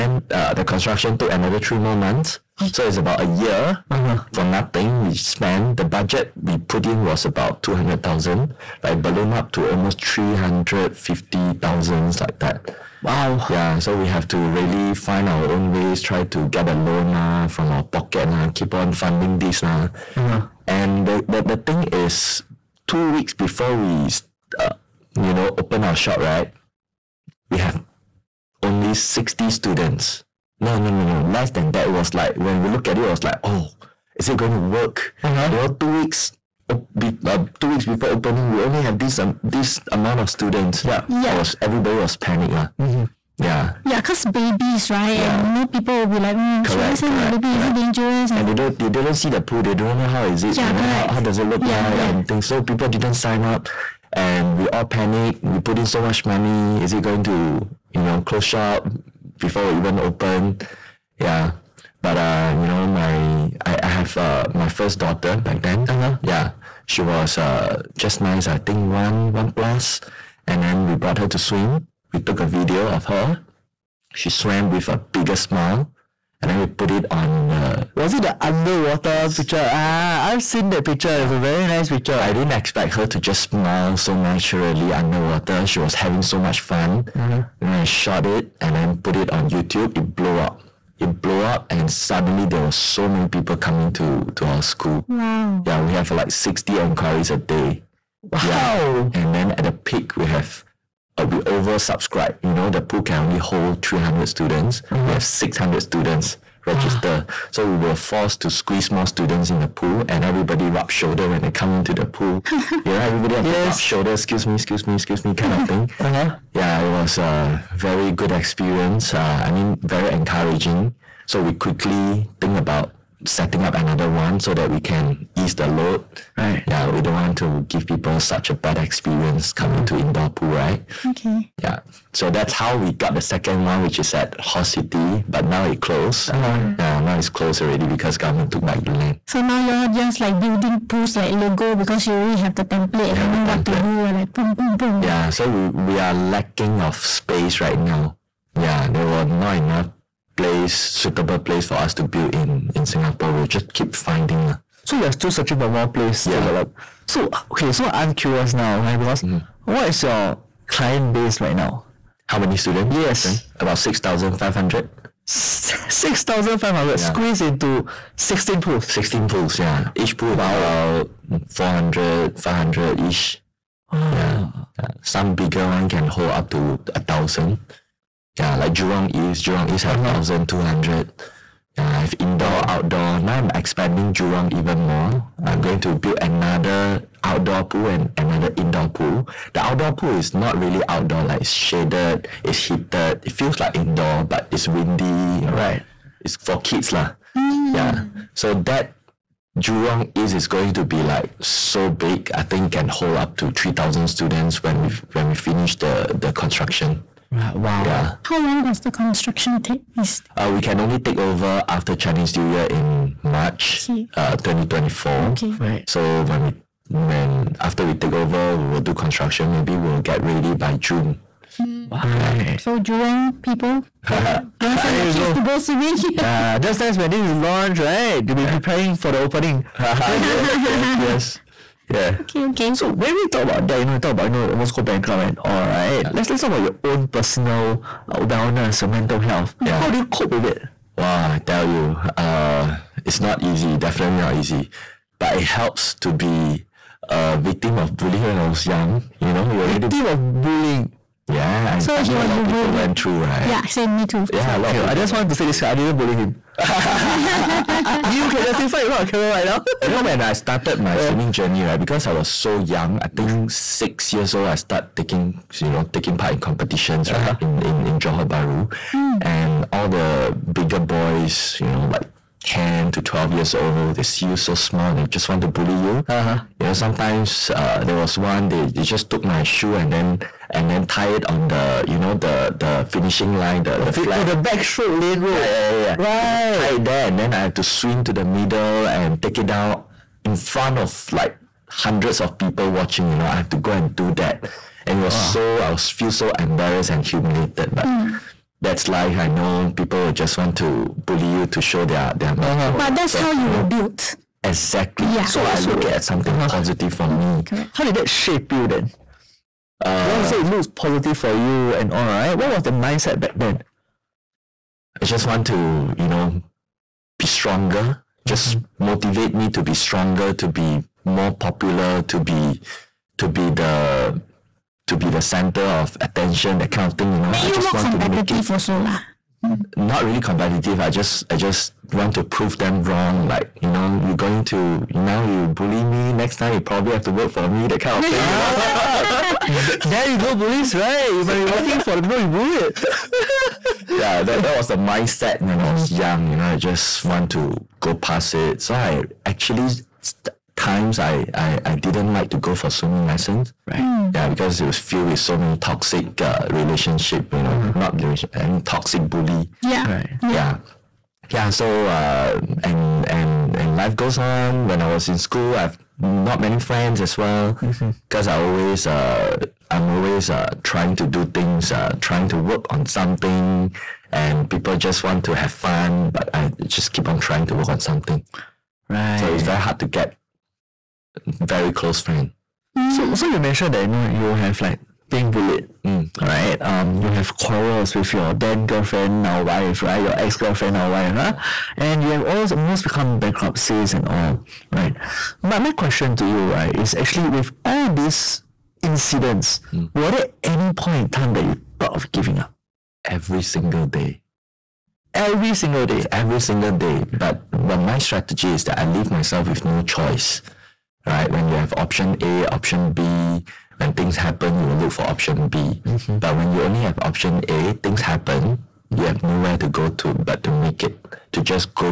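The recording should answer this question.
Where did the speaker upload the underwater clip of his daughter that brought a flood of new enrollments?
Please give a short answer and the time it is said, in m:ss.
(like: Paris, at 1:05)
YouTube, at 1:29.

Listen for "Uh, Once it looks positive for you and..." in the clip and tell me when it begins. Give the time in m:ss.
5:09.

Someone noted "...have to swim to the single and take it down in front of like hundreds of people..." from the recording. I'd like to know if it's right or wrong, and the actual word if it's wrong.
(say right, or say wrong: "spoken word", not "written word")
wrong: "middle", not "single".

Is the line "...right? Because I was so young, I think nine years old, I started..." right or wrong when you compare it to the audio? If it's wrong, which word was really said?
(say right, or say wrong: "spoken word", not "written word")
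wrong: "six", not "nine".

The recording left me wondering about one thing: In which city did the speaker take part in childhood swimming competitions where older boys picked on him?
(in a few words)
Johor Bahru.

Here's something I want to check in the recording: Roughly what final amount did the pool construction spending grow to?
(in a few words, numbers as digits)
350,000.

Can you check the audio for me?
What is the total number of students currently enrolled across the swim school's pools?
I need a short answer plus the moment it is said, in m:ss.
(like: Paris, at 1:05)
6,500, at 2:43.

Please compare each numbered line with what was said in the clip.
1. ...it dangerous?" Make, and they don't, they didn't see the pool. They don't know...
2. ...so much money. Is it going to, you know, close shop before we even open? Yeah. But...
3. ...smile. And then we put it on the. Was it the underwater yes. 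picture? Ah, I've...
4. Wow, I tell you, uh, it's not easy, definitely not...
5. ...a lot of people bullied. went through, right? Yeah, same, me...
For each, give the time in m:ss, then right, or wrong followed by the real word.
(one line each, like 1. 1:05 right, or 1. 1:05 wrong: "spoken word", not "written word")
1. 0:47 wrong: "And", not "Make"
2. 0:55 right
3. 1:15 right
4. 4:00 right
5. 4:12 right.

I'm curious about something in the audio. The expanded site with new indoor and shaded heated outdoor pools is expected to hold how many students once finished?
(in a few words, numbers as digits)
3,000.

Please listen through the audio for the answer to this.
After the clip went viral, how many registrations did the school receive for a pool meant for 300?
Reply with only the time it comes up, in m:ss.
1:45.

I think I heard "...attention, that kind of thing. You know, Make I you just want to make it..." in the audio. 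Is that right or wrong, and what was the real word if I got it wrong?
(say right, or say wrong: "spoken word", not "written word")
right.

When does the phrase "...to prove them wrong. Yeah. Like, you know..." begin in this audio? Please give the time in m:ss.
5:32.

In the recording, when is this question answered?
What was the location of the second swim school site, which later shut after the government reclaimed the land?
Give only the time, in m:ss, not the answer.
2:14.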